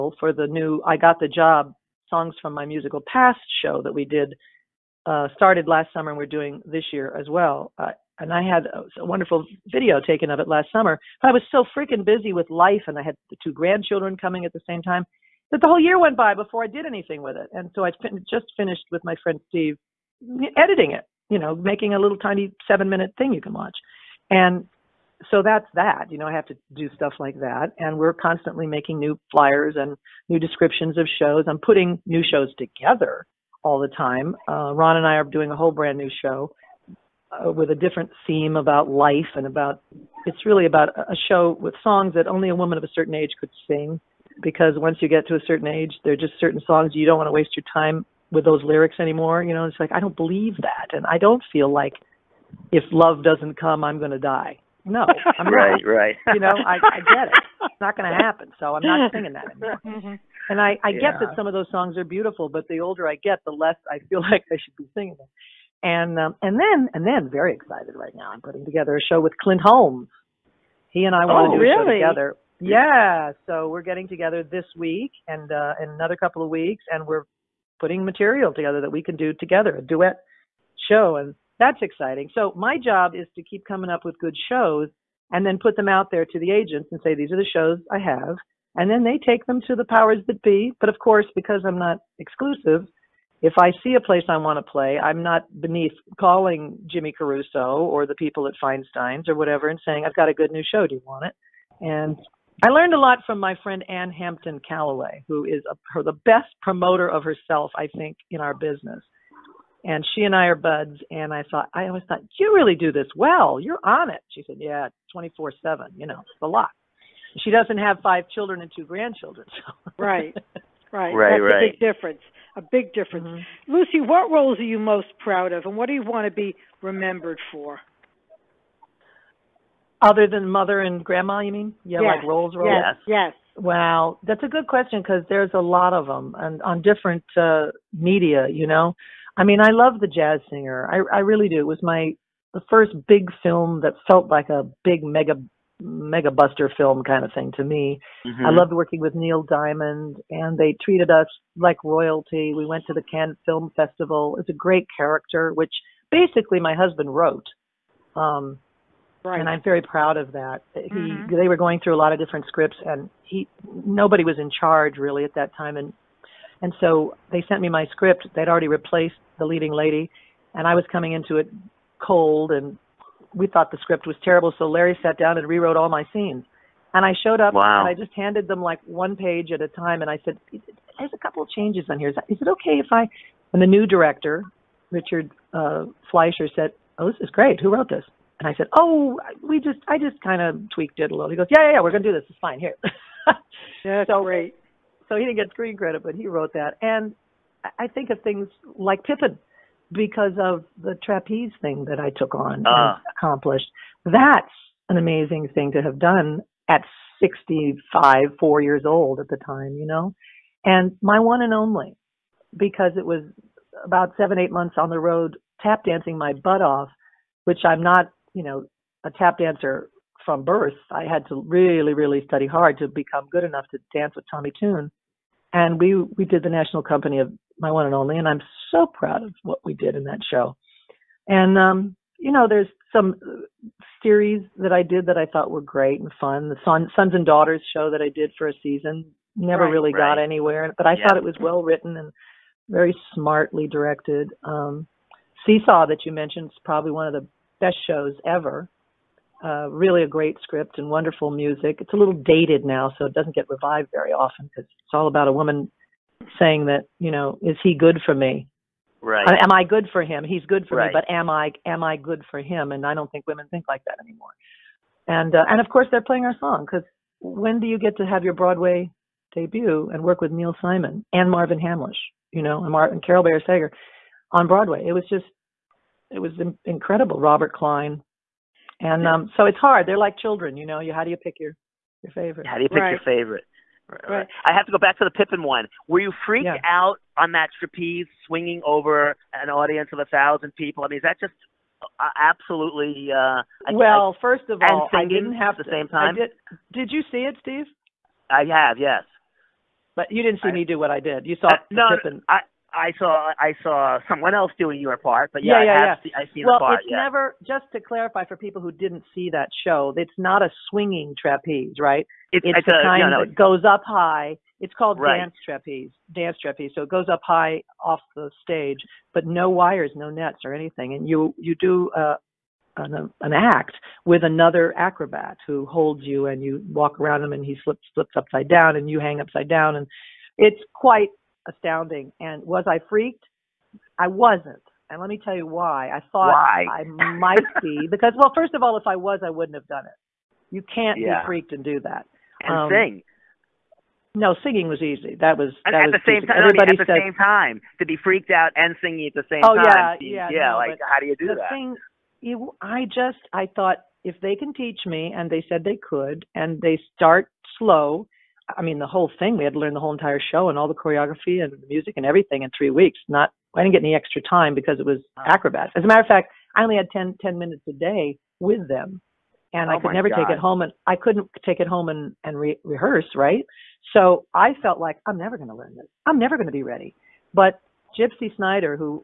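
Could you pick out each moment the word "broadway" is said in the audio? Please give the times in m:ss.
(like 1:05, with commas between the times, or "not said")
4:28, 4:34.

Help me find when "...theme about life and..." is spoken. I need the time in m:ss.
0:38.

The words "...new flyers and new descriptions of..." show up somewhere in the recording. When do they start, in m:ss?
0:28.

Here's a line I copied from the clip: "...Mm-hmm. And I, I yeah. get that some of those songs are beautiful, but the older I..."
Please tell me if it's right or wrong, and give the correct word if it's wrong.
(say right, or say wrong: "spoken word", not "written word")
right.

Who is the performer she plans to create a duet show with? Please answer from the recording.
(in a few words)
Clint Holmes.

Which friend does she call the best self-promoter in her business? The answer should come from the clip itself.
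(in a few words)
Ann Hampton Callaway.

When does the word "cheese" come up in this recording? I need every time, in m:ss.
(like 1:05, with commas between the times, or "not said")
not said.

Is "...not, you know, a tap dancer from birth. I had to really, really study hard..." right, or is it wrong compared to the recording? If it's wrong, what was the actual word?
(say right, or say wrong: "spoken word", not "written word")
right.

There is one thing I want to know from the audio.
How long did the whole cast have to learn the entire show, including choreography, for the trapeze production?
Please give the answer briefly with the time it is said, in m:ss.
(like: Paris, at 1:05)
3 weeks, at 6:02.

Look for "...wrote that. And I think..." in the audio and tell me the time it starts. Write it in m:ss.
3:16.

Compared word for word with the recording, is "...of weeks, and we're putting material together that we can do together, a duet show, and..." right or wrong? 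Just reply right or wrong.
right.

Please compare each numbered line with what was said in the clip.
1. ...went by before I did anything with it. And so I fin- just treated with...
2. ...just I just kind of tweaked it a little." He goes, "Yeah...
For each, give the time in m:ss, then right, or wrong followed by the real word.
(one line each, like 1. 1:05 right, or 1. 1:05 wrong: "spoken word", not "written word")
1. 0:15 wrong: "finished", not "treated"
2. 3:09 right.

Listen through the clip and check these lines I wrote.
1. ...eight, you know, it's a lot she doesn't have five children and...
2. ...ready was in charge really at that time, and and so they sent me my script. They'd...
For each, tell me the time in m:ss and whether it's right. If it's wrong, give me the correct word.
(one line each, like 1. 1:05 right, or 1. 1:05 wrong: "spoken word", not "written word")
1. 1:55 wrong: "seven", not "eight"
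2. 2:43 wrong: "nobody", not "ready".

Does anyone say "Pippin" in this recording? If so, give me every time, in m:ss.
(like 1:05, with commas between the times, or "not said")
3:19, 4:45, 5:01.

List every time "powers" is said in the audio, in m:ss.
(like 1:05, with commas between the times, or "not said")
1:29.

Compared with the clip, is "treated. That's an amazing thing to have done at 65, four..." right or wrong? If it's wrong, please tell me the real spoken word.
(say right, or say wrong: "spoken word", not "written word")
wrong: "accomplished", not "treated".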